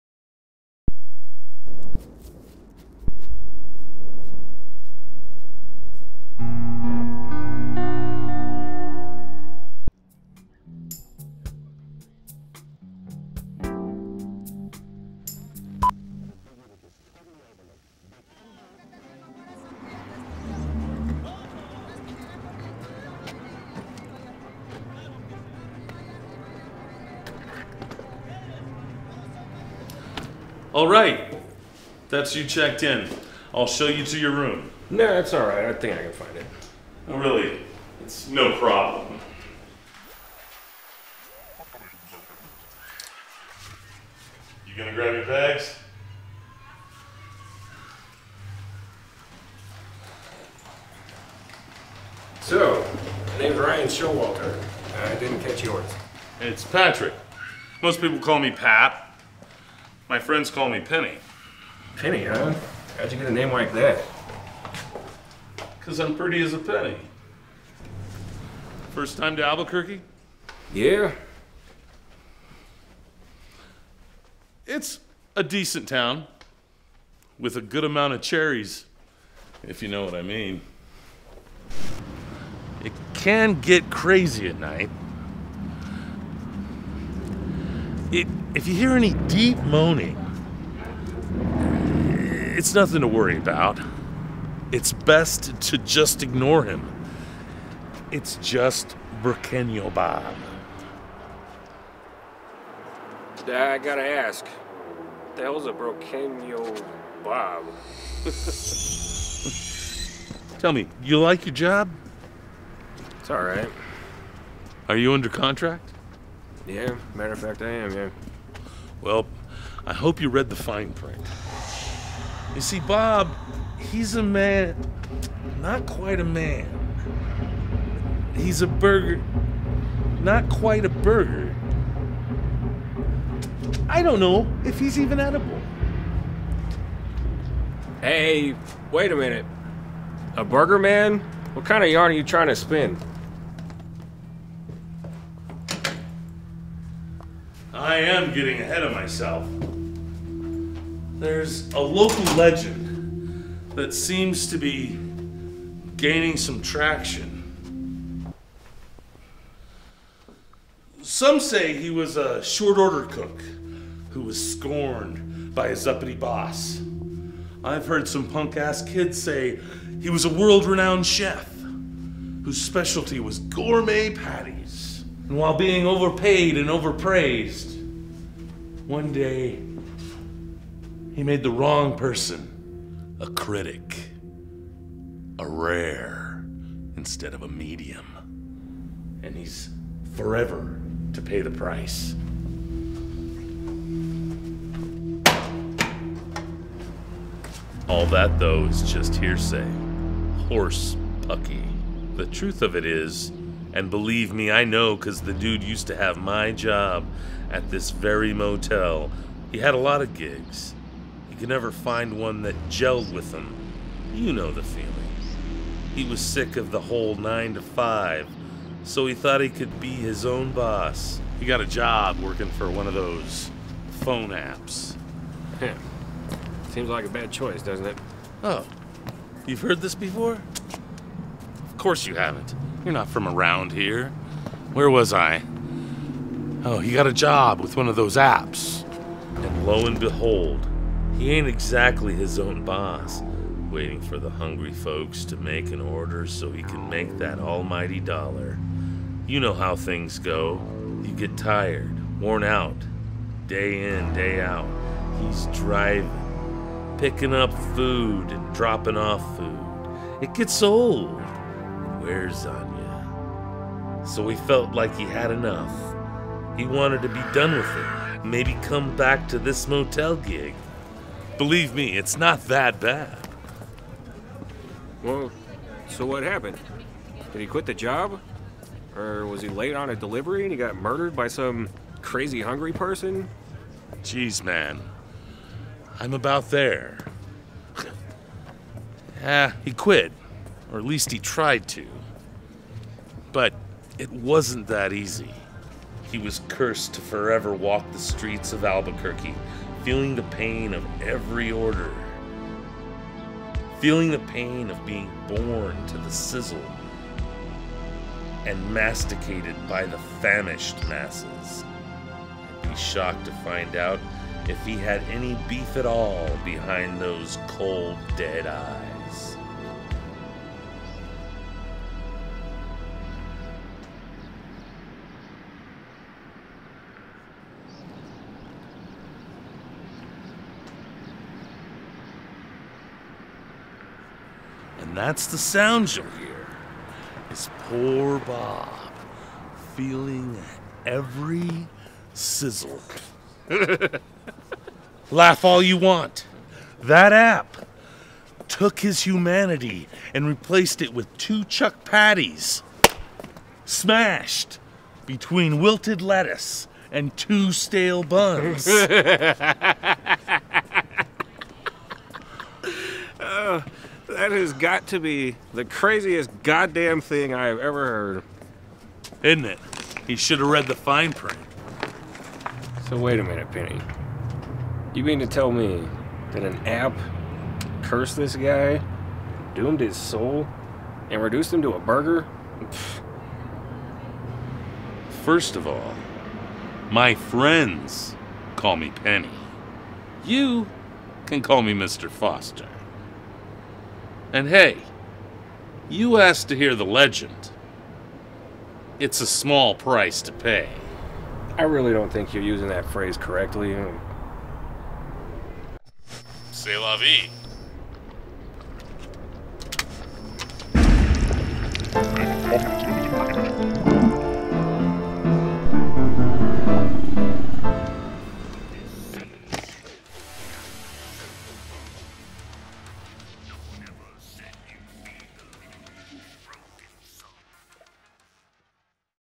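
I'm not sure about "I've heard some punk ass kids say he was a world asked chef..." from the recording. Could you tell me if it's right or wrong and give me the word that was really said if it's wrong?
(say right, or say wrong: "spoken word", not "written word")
wrong: "renowned", not "asked".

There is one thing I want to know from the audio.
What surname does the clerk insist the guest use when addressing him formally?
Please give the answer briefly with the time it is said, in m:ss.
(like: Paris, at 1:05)
Foster, at 6:31.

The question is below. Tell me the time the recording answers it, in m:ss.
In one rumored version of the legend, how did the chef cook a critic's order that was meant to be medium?
3:05.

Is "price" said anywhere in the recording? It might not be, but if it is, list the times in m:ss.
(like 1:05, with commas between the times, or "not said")
3:11, 6:39.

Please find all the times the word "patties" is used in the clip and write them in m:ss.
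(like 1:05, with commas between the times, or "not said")
2:54, 5:51.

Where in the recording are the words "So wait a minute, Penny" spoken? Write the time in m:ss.
6:12.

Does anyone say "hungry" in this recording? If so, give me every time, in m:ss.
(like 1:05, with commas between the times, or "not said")
4:04, 4:42.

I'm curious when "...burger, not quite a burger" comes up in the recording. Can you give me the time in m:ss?
2:08.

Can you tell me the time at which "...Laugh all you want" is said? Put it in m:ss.
5:45.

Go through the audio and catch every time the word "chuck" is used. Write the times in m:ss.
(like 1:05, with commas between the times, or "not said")
5:51.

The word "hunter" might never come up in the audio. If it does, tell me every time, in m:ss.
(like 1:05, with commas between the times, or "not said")
not said.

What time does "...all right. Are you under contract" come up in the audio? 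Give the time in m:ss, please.
1:53.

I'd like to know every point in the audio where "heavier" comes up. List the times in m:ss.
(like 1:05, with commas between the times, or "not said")
not said.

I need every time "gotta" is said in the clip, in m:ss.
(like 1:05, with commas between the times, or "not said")
1:43.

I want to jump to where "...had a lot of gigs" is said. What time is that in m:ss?
3:29.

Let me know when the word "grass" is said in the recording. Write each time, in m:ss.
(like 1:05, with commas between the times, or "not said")
not said.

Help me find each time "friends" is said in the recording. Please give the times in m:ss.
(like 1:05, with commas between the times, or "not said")
1:00, 6:27.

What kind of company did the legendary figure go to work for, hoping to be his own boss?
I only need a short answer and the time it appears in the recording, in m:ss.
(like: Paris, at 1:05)
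phone apps, at 3:44.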